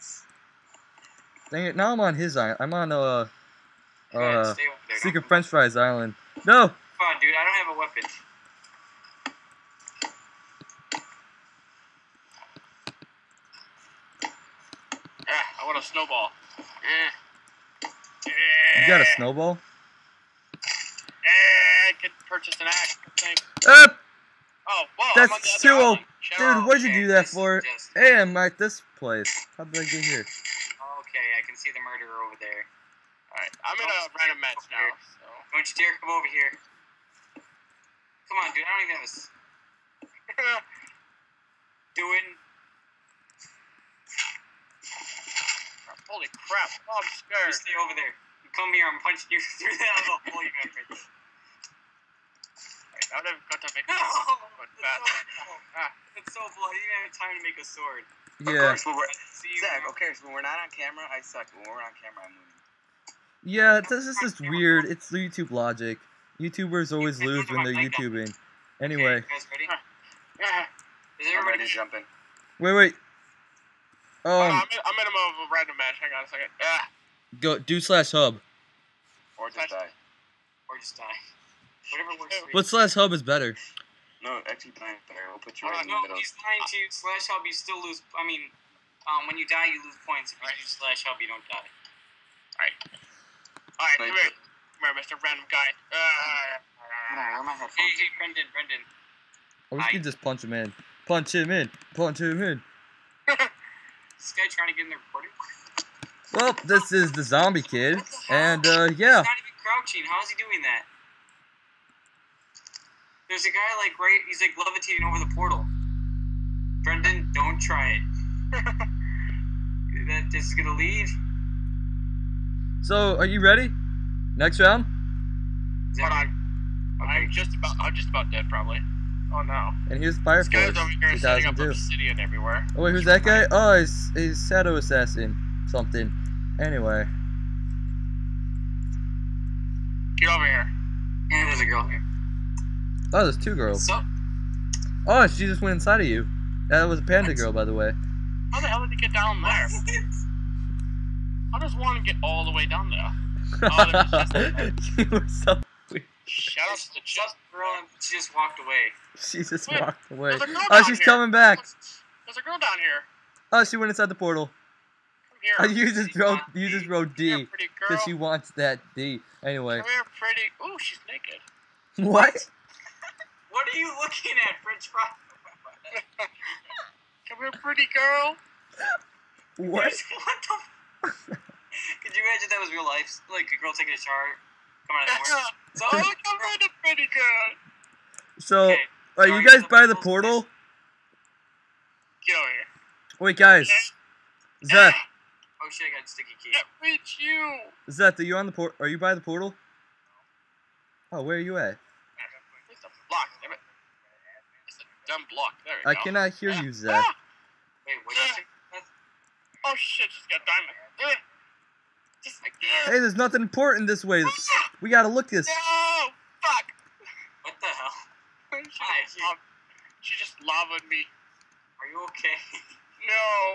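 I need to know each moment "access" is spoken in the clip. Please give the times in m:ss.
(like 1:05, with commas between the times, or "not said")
not said.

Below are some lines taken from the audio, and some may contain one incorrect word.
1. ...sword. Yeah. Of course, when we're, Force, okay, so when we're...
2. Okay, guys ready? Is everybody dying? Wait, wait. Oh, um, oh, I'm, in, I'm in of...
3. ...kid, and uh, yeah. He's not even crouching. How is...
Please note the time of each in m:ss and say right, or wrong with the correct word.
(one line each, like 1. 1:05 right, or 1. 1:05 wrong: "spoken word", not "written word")
1. 0:57 wrong: "Zach", not "Force"
2. 1:09 wrong: "jumping", not "dying"
3. 1:47 right.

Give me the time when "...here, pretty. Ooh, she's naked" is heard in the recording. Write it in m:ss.
2:49.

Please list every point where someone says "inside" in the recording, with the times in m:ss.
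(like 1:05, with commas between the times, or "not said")
2:25, 2:43.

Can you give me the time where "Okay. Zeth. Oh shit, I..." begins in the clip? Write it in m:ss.
3:14.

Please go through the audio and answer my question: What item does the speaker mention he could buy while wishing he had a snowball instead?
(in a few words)
An axe.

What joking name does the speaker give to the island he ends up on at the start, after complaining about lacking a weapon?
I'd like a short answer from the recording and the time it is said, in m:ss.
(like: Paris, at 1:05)
Secret French Fries Island, at 0:05.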